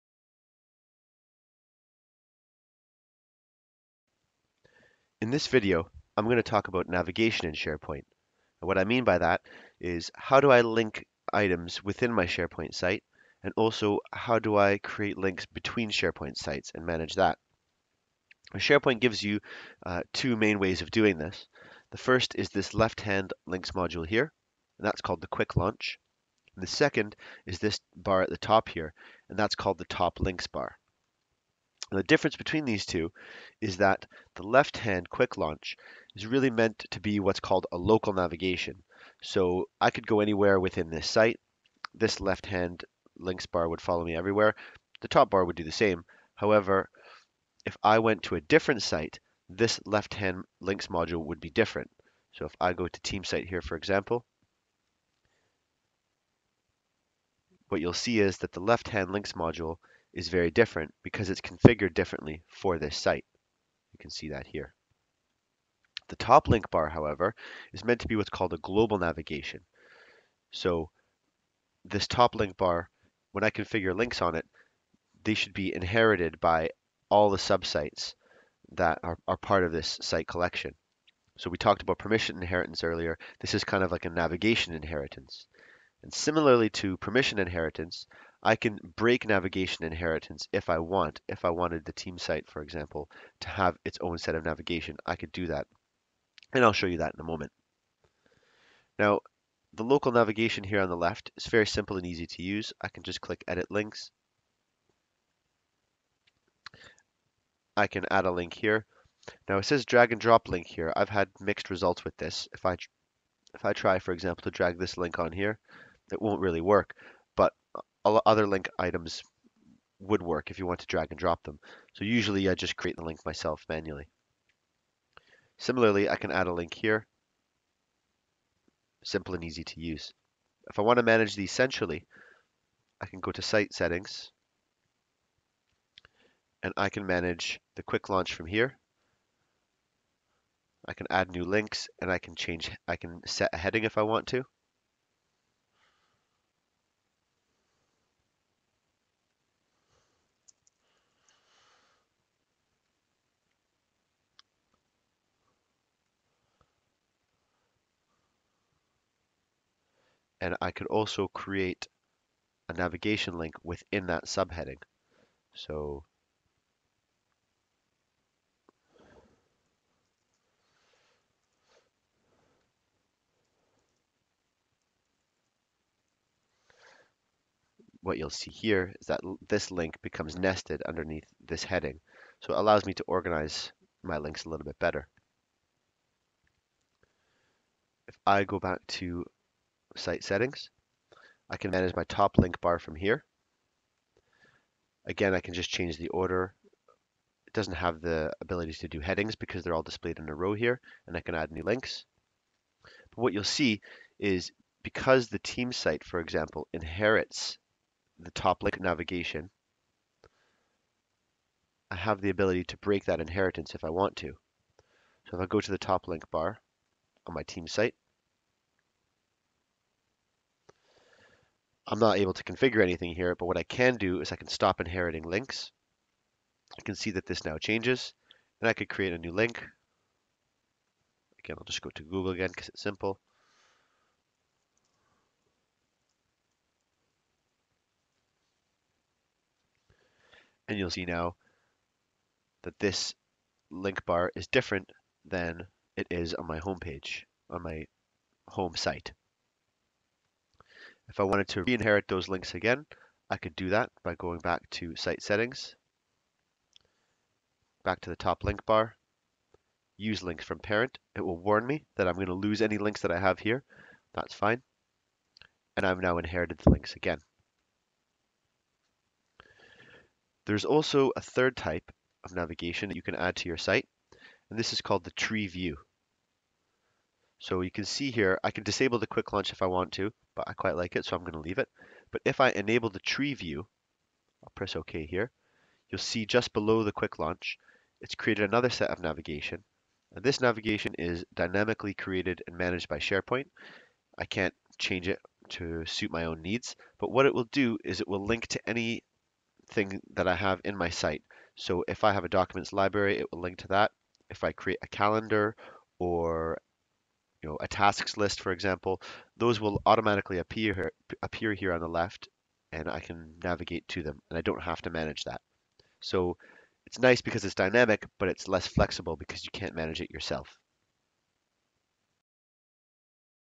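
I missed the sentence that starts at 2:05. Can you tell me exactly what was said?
Similarly, I can add a link here.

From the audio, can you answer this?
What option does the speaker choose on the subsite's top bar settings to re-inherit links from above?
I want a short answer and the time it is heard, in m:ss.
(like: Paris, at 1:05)
Use links from parent, at 4:19.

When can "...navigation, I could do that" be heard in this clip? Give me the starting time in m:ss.
1:34.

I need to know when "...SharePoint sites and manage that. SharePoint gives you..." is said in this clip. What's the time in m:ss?
0:15.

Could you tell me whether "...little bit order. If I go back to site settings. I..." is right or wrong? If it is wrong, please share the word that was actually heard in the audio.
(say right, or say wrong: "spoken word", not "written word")
wrong: "better", not "order".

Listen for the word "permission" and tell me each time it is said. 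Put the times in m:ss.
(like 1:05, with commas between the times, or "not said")
1:21, 1:26.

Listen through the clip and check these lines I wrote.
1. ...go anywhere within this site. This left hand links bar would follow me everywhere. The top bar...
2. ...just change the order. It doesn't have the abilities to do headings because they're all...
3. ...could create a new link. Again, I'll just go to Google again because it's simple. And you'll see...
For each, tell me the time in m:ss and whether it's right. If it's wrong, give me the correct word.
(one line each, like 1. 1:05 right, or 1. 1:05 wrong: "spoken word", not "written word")
1. 0:40 right
2. 3:15 right
3. 3:48 right.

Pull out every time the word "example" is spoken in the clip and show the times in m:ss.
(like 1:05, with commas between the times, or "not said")
0:53, 1:32, 1:54, 3:26, 5:08.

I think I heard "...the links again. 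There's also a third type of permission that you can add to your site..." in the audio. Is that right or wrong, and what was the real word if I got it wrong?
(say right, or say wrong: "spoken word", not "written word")
wrong: "navigation", not "permission".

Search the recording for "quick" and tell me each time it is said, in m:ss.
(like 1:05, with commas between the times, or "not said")
0:25, 0:35, 2:17, 4:39, 4:46.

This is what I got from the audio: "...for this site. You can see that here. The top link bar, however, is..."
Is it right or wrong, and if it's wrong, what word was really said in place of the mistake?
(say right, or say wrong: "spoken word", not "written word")
right.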